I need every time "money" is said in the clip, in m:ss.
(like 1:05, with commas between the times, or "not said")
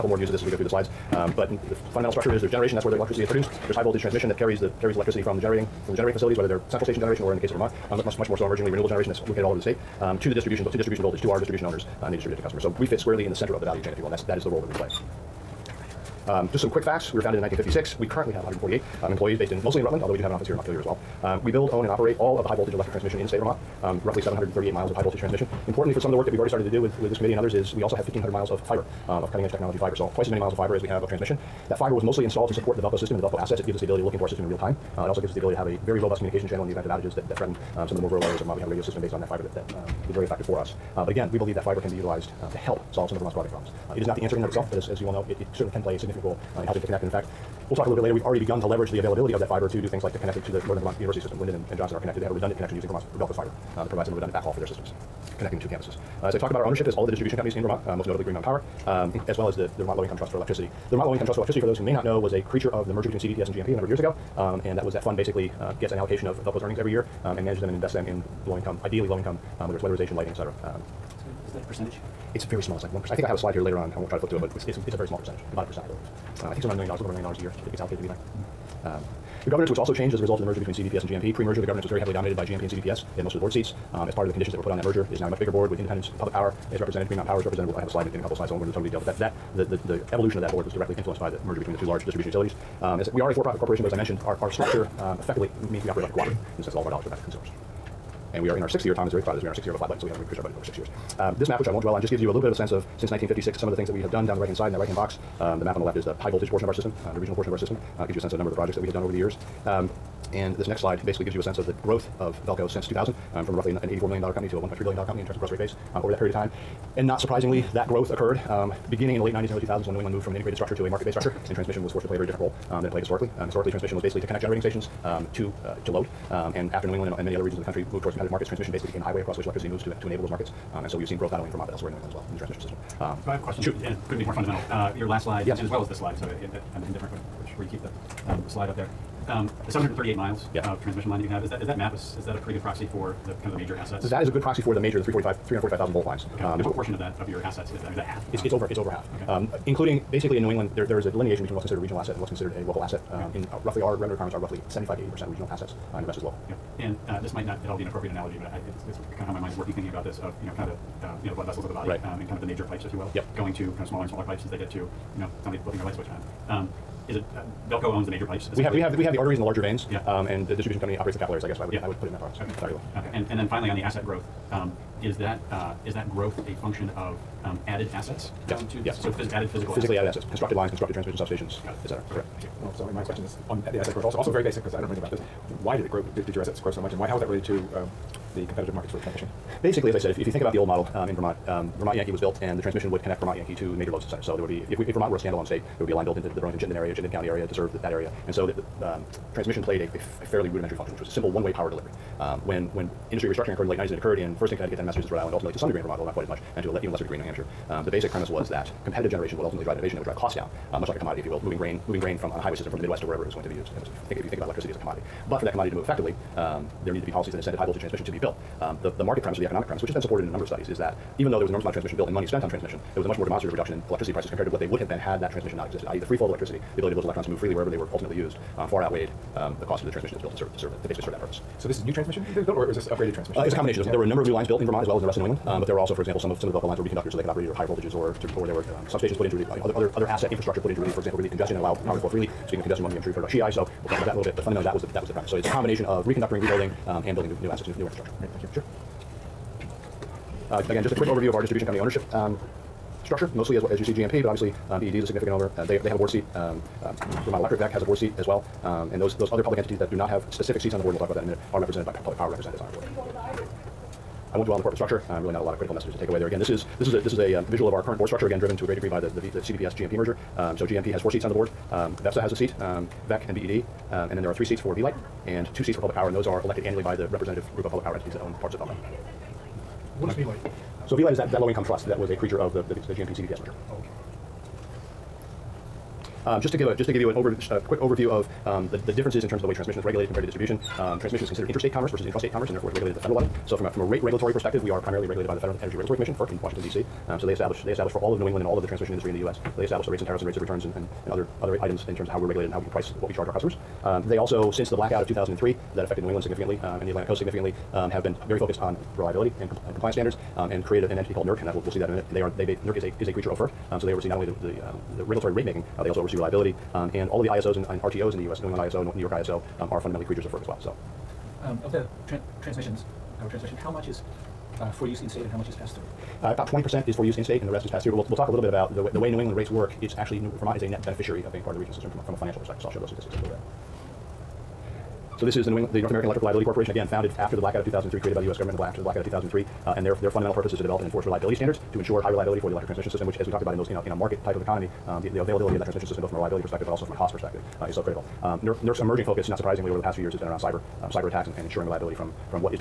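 3:42.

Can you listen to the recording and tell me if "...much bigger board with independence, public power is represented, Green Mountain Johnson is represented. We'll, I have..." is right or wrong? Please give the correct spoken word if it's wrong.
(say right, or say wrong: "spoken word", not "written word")
wrong: "Power", not "Johnson".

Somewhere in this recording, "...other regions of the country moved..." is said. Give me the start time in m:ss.
2:07.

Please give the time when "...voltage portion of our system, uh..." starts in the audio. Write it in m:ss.
1:46.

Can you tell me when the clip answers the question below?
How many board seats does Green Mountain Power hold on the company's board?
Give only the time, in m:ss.
4:31.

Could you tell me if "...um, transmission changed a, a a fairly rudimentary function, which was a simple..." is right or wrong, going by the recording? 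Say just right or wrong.
wrong.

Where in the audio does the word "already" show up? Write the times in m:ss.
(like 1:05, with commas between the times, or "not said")
0:26, 0:48.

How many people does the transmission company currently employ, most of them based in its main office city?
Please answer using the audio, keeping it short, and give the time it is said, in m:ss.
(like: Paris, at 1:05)
148, at 0:18.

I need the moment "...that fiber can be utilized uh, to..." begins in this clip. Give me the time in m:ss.
0:41.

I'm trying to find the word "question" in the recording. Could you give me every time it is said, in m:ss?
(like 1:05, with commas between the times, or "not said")
2:13, 3:03.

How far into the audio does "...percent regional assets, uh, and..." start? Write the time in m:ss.
2:35.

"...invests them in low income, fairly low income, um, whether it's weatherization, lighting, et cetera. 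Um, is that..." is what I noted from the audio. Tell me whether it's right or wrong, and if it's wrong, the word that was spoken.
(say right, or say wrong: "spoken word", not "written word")
wrong: "ideally", not "fairly".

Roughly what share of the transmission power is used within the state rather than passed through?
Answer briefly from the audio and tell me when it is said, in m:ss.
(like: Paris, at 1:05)
20%, at 5:26.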